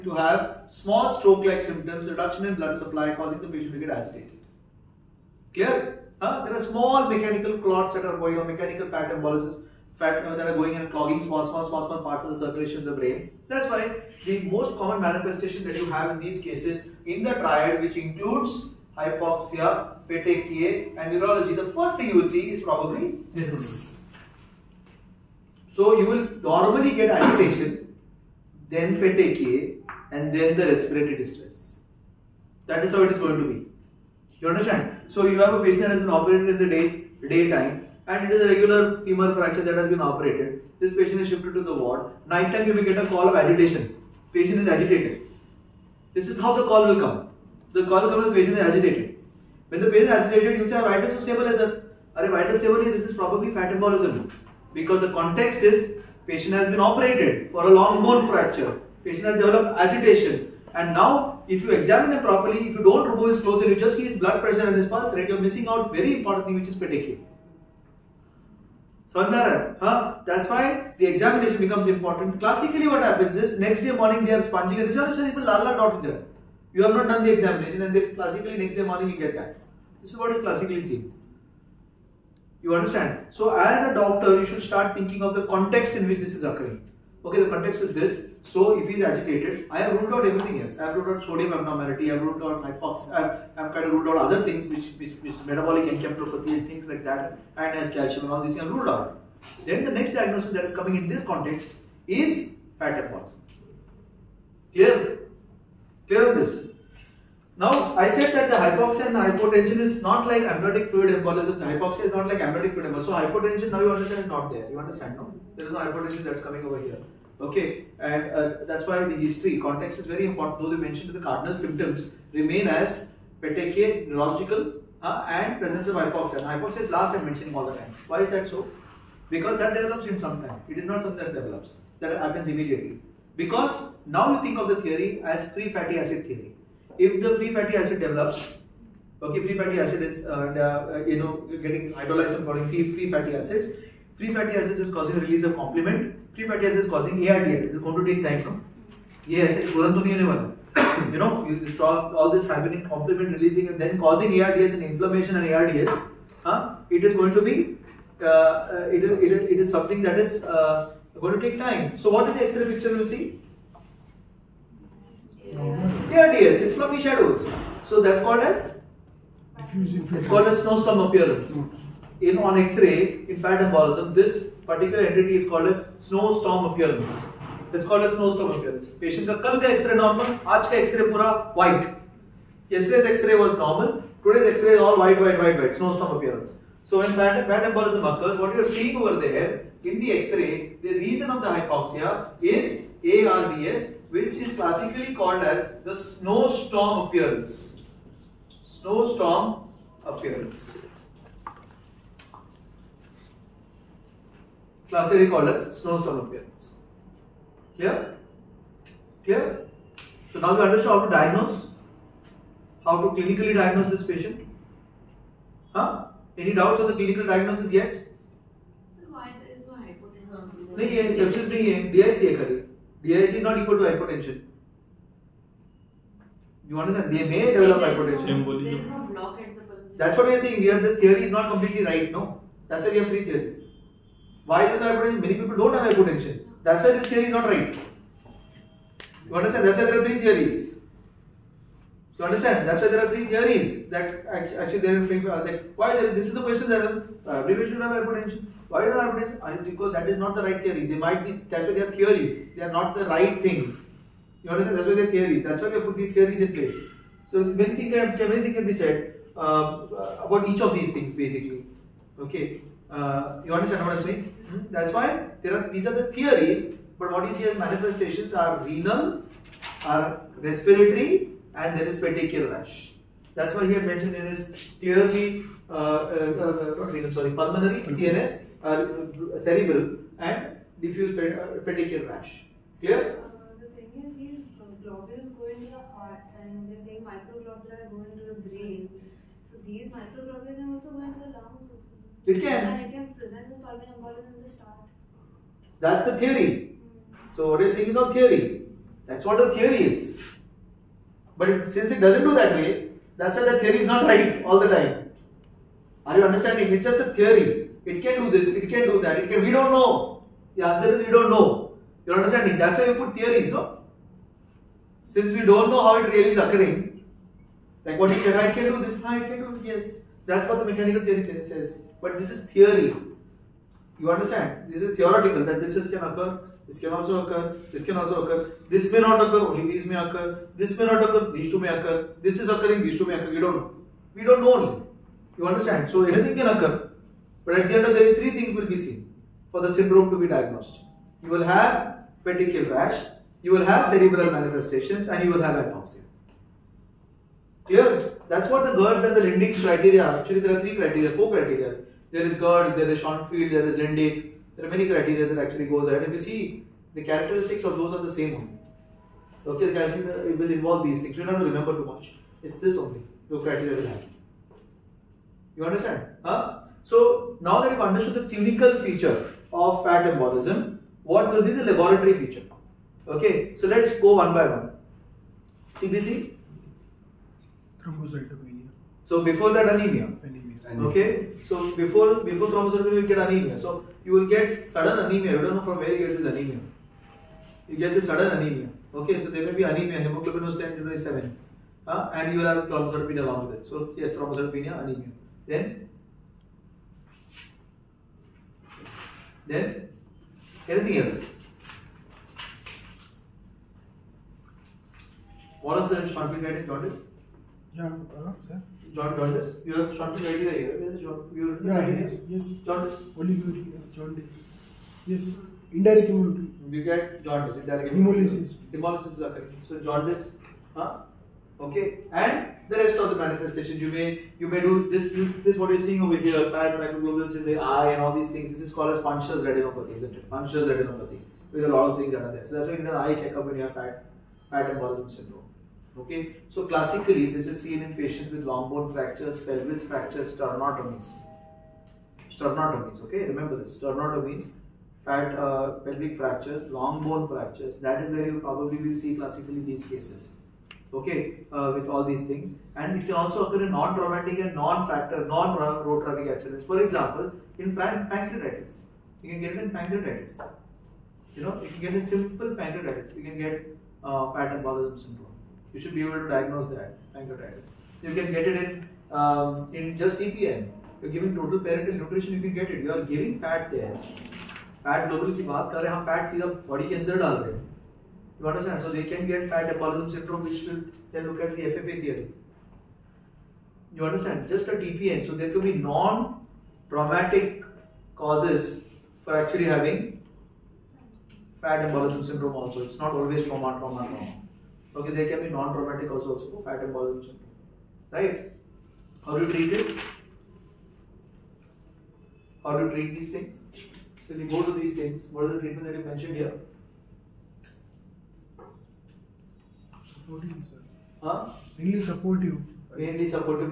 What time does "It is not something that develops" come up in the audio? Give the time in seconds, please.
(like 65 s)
130 s.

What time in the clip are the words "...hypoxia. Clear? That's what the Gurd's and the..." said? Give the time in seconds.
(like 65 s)
345 s.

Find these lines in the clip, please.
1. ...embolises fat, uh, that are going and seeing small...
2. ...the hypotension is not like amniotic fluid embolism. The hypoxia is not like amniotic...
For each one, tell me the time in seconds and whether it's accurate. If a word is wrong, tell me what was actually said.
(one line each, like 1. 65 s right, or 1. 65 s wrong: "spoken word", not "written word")
1. 9 s wrong: "clogging", not "seeing"
2. 109 s right.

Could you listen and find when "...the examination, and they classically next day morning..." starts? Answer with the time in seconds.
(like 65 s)
77 s.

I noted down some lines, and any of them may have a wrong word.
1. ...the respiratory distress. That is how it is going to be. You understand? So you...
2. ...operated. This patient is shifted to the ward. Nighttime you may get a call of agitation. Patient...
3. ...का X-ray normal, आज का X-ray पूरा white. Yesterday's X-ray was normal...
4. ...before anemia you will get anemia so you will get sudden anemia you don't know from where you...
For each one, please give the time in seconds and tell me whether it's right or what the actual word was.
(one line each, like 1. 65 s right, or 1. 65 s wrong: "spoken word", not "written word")
1. 30 s right
2. 40 s right
3. 179 s right
4. 382 s wrong: "thrombocytopenia", not "anemia".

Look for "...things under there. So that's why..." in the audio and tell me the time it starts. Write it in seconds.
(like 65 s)
431 s.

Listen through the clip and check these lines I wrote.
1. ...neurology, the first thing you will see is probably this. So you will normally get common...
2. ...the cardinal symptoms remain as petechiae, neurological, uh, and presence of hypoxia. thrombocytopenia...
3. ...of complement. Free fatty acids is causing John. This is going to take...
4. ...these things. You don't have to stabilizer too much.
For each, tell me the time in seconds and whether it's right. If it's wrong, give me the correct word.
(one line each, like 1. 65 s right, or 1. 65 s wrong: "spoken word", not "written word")
1. 21 s wrong: "agitation", not "common"
2. 121 s wrong: "hypoxia", not "thrombocytopenia"
3. 145 s wrong: "ARDS", not "John"
4. 360 s wrong: "remember", not "stabilizer".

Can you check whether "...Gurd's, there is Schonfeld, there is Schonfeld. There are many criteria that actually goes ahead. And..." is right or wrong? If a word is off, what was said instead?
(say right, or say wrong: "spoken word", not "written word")
wrong: "Lindy", not "Schonfeld".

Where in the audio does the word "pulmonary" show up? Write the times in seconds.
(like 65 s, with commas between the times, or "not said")
277 s.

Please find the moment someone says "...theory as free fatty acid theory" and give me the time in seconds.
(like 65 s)
134 s.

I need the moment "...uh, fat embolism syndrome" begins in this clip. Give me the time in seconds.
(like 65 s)
464 s.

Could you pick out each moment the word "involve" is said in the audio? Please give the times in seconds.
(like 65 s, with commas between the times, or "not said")
360 s.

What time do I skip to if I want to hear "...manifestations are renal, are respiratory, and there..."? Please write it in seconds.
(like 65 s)
267 s.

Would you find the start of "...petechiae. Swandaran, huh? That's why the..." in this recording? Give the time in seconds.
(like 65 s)
66 s.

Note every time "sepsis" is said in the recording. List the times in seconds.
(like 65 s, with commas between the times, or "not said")
221 s.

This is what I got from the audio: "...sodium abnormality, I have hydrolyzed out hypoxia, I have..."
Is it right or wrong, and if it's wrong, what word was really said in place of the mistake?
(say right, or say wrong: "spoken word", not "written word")
wrong: "ruled", not "hydrolyzed".